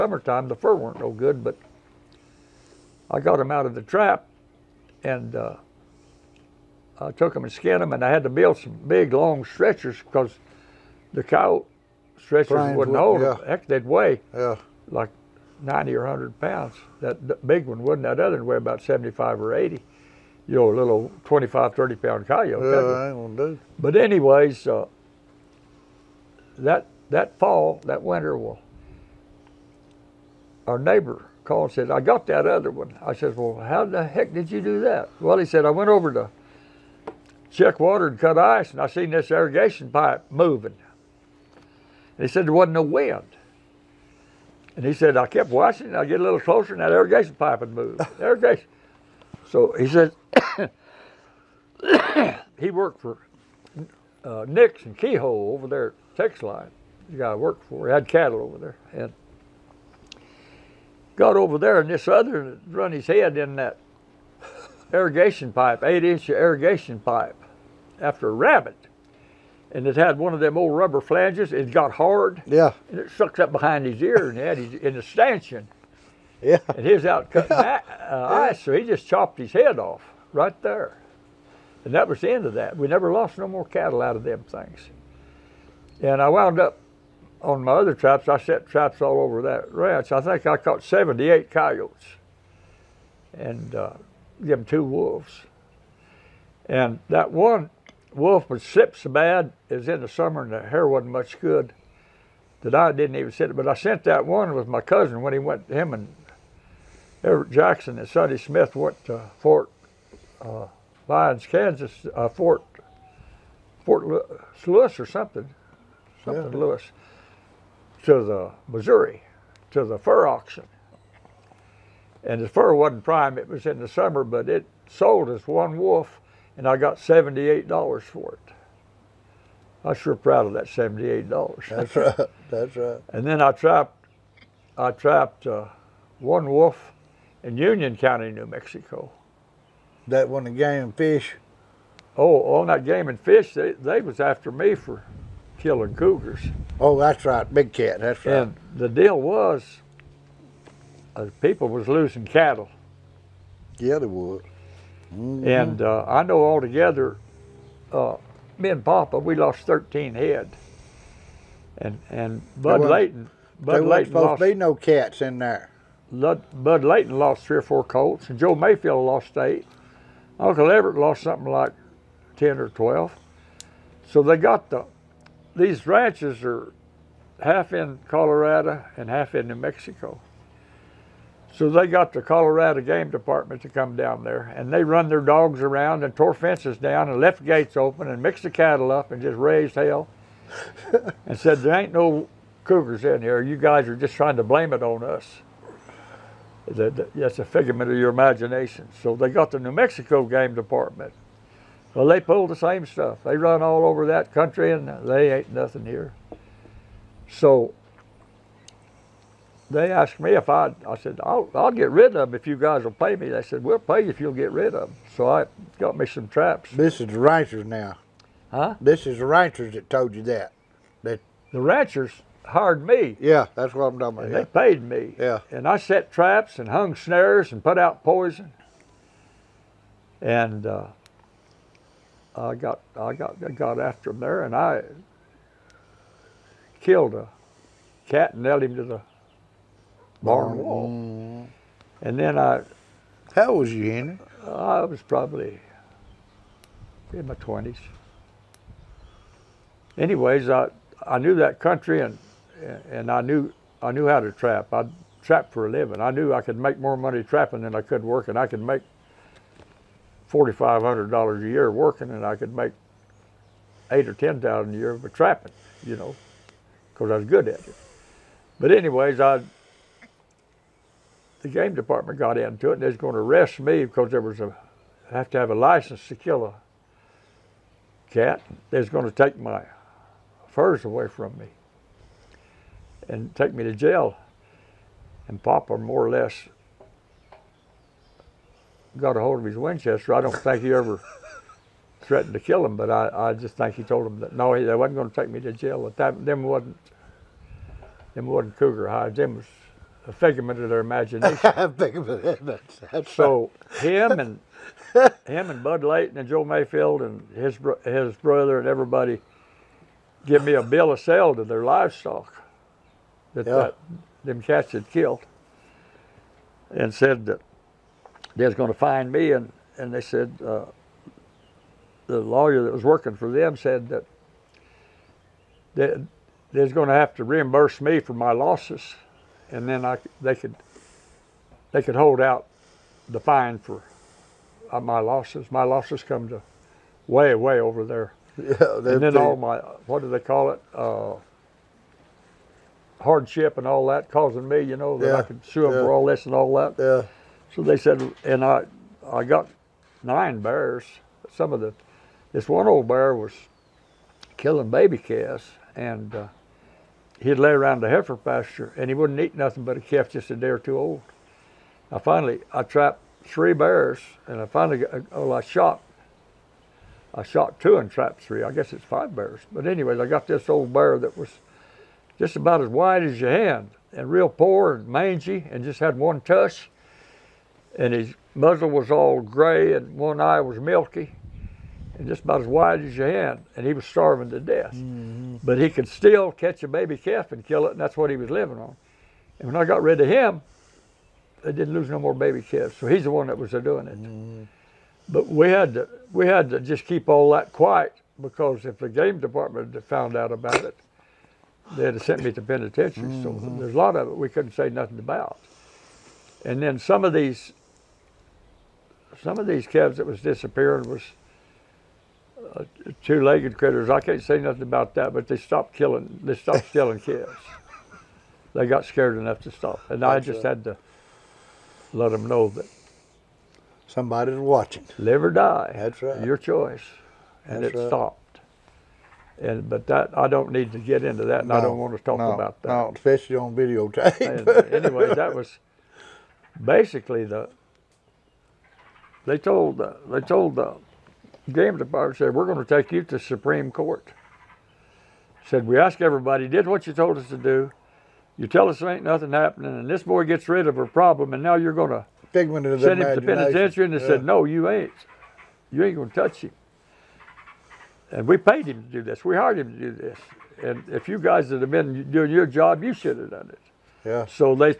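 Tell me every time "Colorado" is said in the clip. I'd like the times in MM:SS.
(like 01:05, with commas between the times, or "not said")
02:58, 03:02.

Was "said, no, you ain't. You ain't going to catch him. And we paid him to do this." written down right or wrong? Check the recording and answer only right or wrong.
wrong.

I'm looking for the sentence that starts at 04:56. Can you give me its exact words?
Them wasn't them wasn't cougar hides.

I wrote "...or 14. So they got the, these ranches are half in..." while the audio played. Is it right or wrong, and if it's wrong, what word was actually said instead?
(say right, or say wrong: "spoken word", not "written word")
wrong: "12", not "14".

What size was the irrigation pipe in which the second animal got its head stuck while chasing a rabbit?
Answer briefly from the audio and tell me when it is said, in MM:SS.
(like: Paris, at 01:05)
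8 inch, at 01:05.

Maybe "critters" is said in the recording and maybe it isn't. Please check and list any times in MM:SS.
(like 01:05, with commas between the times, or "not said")
06:53.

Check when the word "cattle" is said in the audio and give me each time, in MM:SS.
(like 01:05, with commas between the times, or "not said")
00:58, 01:23, 02:32, 03:08.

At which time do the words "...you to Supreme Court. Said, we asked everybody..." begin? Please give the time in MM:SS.
07:22.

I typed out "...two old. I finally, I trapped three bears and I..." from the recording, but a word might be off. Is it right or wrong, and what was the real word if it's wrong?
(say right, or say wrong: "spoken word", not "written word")
right.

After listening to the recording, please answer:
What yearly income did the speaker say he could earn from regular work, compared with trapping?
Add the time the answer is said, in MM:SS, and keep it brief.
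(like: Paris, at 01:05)
$4,500, at 04:20.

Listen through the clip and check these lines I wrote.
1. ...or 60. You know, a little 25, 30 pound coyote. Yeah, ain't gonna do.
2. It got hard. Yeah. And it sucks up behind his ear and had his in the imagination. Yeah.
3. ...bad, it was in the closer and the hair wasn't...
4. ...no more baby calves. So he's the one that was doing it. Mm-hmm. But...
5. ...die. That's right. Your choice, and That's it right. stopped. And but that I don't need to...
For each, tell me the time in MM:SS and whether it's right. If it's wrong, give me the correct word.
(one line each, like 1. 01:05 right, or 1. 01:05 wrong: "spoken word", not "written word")
1. 00:19 wrong: "80", not "60"
2. 01:11 wrong: "stanchion", not "imagination"
3. 01:39 wrong: "summer", not "closer"
4. 06:31 right
5. 07:05 right.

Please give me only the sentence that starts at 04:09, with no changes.
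Anyways, I, I knew that country and, and I, knew, I knew how to trap.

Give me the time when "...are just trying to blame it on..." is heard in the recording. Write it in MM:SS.
03:13.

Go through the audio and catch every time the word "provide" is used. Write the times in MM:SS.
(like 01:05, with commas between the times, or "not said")
not said.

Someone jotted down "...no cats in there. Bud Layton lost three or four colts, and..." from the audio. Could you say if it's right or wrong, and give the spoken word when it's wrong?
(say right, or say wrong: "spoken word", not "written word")
right.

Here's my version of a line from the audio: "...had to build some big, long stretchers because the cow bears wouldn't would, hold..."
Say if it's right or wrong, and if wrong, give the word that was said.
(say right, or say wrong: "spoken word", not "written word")
wrong: "stretchers", not "bears".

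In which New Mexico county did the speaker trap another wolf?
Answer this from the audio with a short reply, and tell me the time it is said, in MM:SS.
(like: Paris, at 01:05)
Union County, at 02:17.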